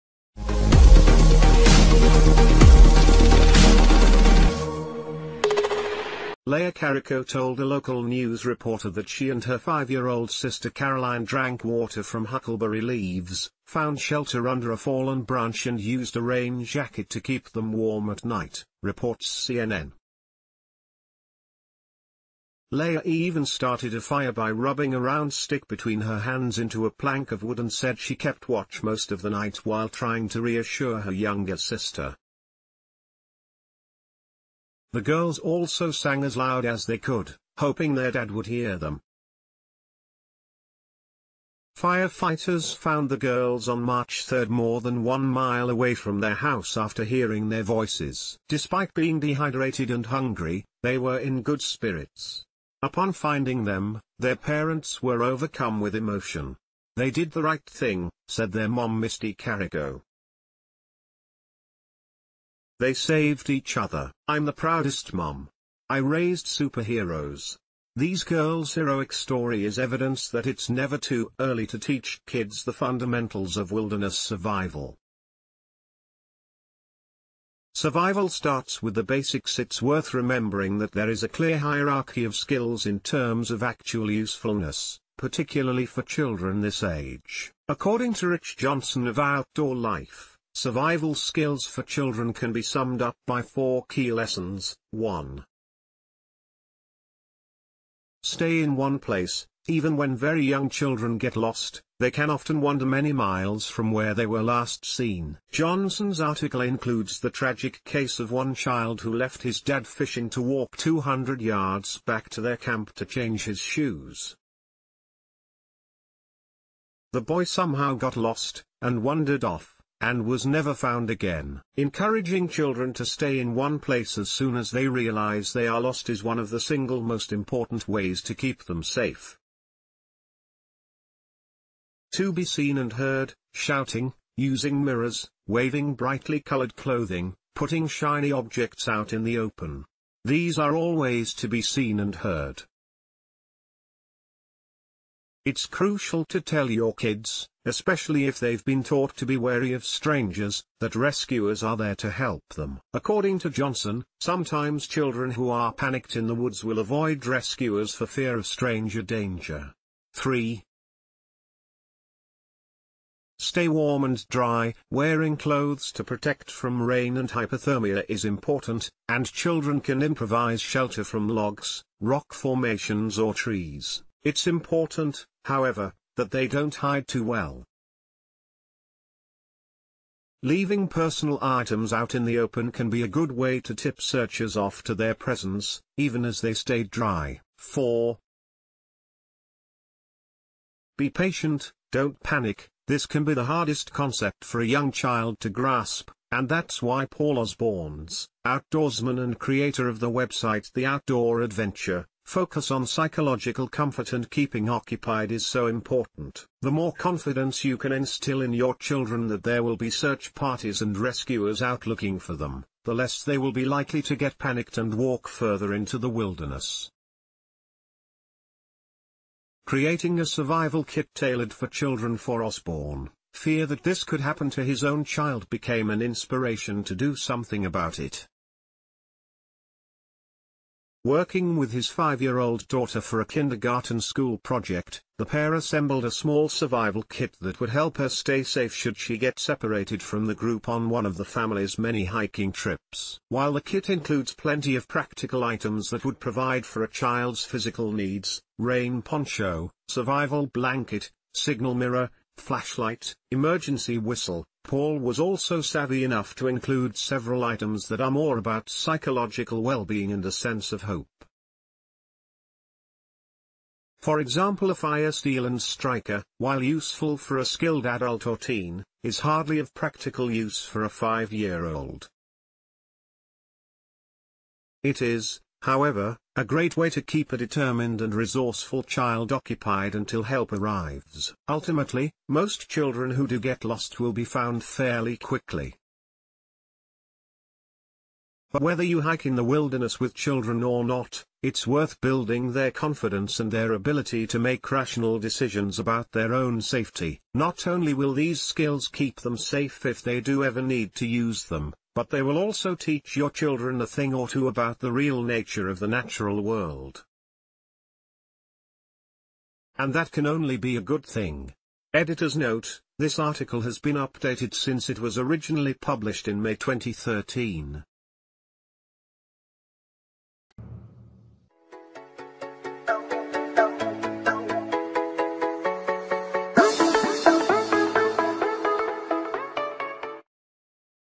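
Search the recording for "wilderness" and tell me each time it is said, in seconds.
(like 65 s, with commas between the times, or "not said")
73 s, 216 s, 289 s.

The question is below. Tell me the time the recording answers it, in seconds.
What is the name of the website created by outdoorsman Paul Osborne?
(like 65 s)
200 s.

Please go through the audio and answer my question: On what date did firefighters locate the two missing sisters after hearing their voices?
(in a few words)
March 3.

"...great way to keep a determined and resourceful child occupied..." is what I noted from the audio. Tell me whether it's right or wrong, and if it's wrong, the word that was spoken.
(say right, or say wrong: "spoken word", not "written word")
right.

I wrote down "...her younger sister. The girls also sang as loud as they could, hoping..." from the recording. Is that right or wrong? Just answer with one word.
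right.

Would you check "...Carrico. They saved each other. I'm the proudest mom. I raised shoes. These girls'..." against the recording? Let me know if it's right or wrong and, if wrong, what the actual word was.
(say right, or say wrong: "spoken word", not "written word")
wrong: "superheroes", not "shoes".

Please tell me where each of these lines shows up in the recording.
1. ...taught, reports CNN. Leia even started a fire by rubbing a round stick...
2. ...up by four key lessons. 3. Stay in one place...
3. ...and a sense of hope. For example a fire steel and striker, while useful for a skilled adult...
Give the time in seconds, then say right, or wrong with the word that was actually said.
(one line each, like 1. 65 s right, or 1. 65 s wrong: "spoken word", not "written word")
1. 18 s wrong: "night", not "taught"
2. 93 s wrong: "1", not "3"
3. 260 s right.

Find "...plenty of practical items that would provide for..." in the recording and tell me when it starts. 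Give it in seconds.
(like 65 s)
244 s.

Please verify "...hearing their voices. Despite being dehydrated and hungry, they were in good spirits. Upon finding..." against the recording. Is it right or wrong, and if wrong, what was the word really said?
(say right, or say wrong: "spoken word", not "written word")
right.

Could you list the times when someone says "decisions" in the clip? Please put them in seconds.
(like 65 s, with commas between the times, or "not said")
295 s.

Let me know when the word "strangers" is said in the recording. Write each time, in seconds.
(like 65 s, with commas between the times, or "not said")
149 s, 158 s.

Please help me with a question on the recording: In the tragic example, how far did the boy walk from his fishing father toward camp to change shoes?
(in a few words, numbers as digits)
200 yards.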